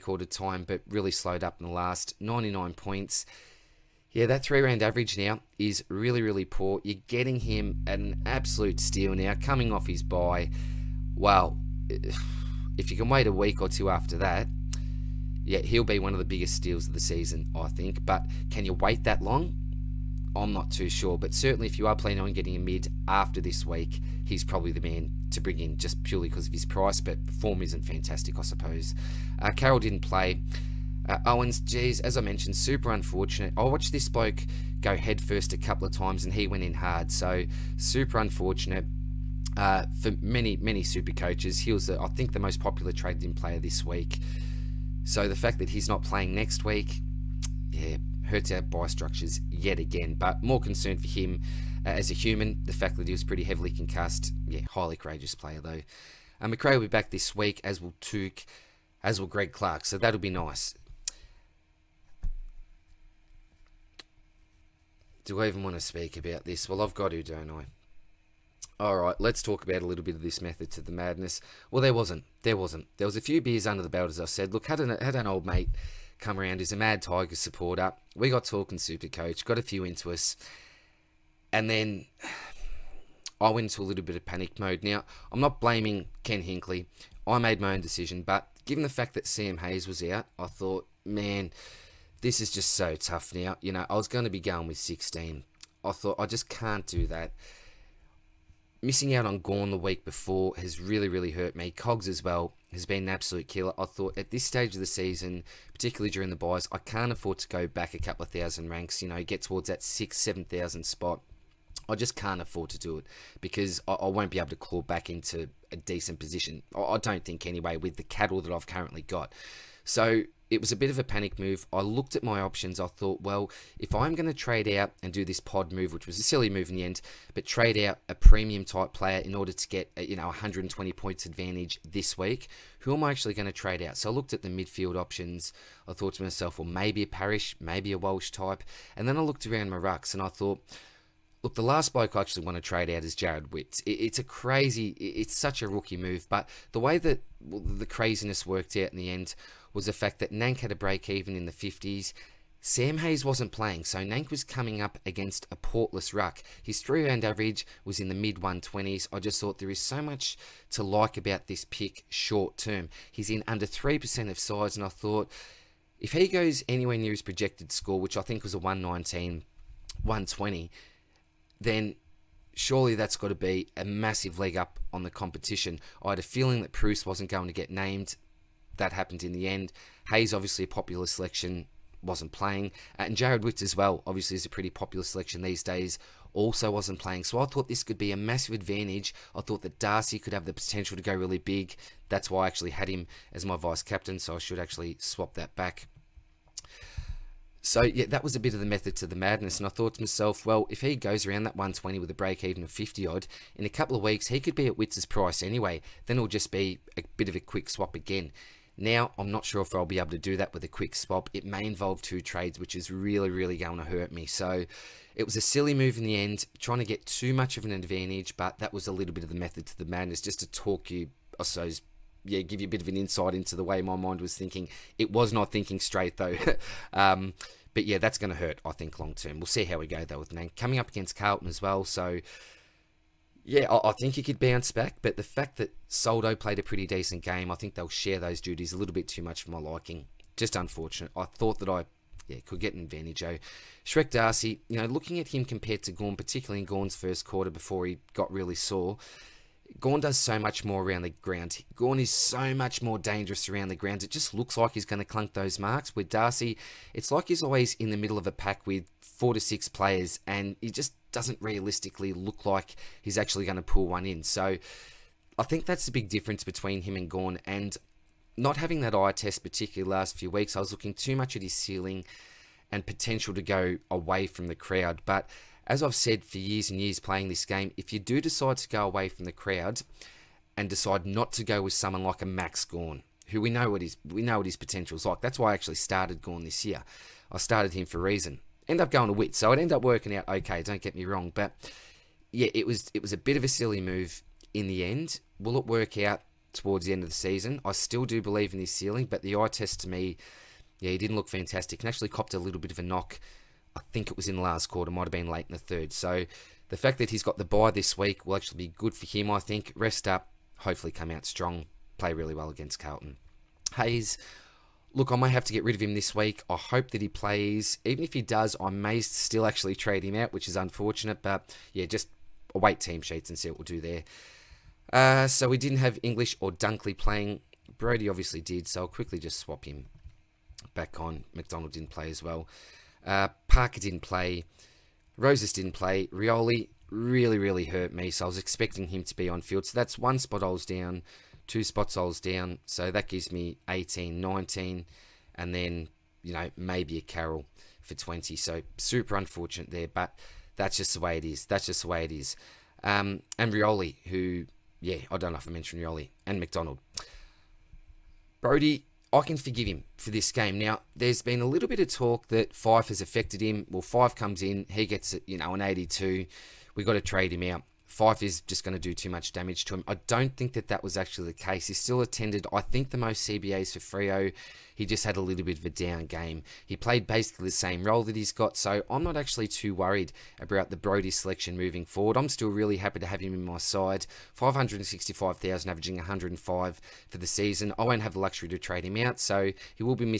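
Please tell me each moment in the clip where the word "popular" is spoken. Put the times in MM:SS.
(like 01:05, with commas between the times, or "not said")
00:42, 03:00, 03:04.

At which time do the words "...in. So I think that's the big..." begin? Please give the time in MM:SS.
04:24.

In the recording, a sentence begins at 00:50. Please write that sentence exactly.
But more concern for him uh, as a human.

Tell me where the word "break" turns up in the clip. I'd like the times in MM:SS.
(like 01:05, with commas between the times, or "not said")
02:30, 03:22.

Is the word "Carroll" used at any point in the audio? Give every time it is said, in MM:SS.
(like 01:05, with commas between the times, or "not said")
00:29, 05:47.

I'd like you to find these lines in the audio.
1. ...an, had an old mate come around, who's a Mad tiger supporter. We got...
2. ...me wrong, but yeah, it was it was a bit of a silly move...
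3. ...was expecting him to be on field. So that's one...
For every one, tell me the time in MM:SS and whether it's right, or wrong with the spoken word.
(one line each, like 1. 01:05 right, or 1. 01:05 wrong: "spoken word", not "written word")
1. 01:14 right
2. 04:50 right
3. 05:38 right.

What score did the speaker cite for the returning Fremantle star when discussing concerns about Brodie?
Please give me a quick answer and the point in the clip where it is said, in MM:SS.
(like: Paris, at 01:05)
82, at 06:05.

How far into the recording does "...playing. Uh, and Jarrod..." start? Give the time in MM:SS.
03:02.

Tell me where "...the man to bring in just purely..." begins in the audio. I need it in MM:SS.
00:24.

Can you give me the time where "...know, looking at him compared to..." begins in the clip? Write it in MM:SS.
04:04.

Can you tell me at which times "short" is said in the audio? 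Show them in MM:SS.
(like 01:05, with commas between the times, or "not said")
02:42.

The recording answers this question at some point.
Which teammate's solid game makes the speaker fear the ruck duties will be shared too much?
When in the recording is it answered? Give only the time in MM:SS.
03:55.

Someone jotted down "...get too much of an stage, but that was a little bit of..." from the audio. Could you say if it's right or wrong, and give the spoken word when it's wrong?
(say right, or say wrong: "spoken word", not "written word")
wrong: "advantage", not "stage".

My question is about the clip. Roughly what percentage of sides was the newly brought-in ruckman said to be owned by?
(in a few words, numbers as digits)
under 3%.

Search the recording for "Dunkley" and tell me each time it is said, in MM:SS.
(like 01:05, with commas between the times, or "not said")
05:26.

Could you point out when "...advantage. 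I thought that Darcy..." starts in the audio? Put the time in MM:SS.
03:08.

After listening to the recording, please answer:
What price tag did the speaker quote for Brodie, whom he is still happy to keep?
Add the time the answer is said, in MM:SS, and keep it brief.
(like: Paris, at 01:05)
565,000, at 06:24.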